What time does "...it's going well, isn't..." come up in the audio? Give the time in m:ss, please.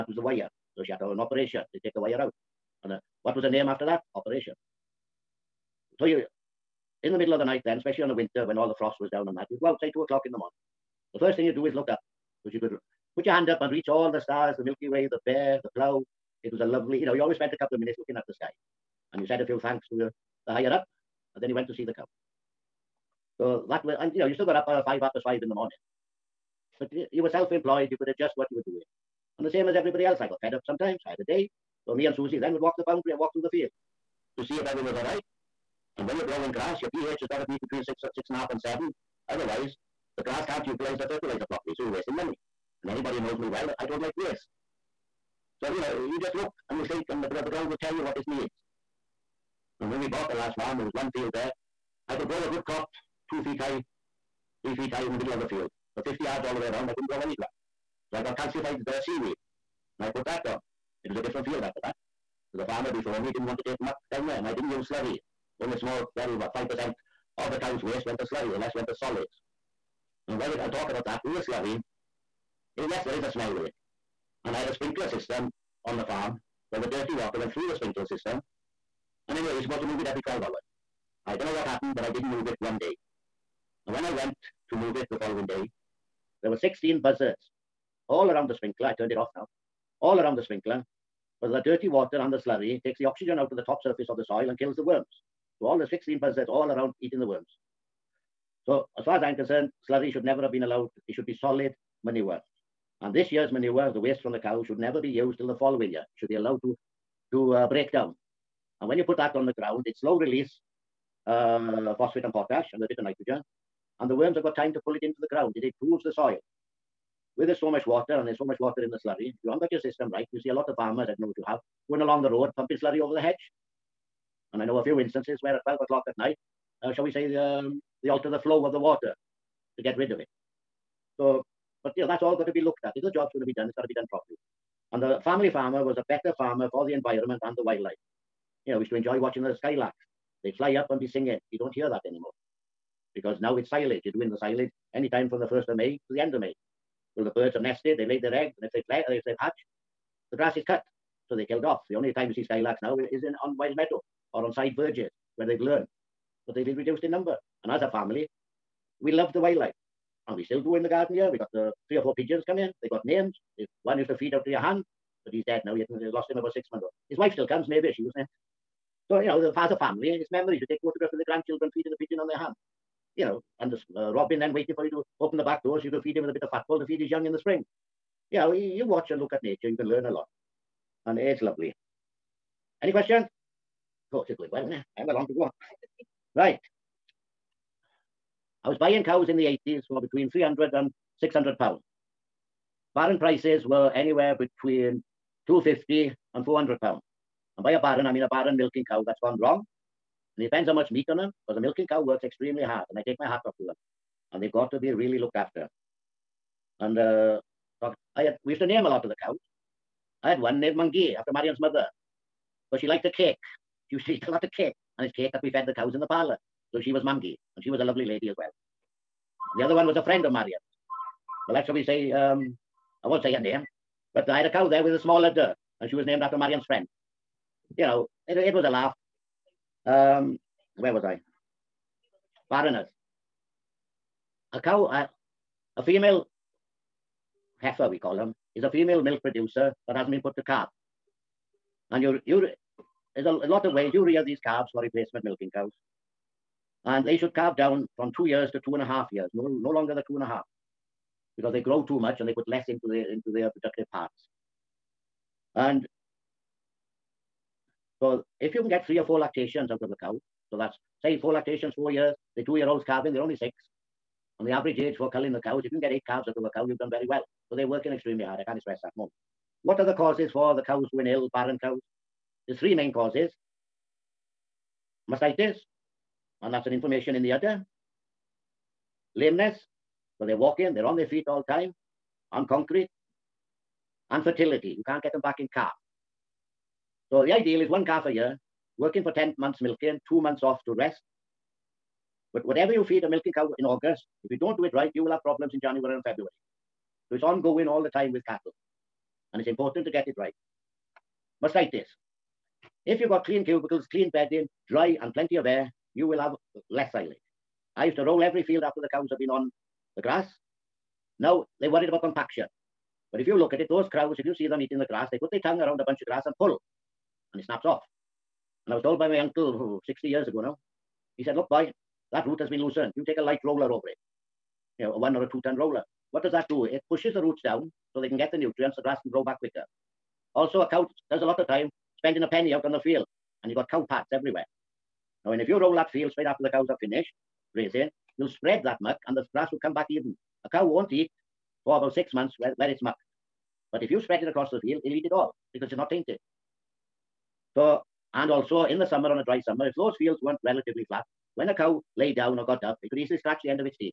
3:04.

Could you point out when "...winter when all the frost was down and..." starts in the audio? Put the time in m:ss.
0:08.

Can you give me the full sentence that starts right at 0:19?
And you said a few thanks to the, the higher up.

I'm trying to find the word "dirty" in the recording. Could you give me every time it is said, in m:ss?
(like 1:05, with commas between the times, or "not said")
1:16, 1:31.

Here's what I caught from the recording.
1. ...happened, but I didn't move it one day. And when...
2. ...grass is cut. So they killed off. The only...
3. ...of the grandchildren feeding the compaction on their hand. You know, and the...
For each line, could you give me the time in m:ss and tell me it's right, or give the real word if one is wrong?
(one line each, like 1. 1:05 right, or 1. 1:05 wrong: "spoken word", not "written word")
1. 1:21 right
2. 2:30 right
3. 2:51 wrong: "pigeon", not "compaction".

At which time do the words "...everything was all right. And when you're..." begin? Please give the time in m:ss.
0:34.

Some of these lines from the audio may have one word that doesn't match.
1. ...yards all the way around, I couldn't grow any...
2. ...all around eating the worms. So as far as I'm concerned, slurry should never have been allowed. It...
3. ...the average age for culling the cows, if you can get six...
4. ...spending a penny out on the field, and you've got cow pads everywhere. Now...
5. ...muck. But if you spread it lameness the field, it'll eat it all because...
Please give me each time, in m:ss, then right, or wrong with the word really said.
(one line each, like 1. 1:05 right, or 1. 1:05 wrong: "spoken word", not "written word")
1. 0:56 right
2. 1:36 right
3. 4:24 wrong: "eight", not "six"
4. 5:31 right
5. 5:42 wrong: "across", not "lameness".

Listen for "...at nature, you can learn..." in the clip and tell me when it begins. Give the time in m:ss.
2:59.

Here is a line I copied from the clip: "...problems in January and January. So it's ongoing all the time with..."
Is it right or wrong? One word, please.
wrong.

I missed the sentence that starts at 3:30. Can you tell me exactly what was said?
I had one named Mamgi after Marion's mother, because she liked the cake.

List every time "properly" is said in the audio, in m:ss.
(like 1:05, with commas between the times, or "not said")
0:41, 2:14.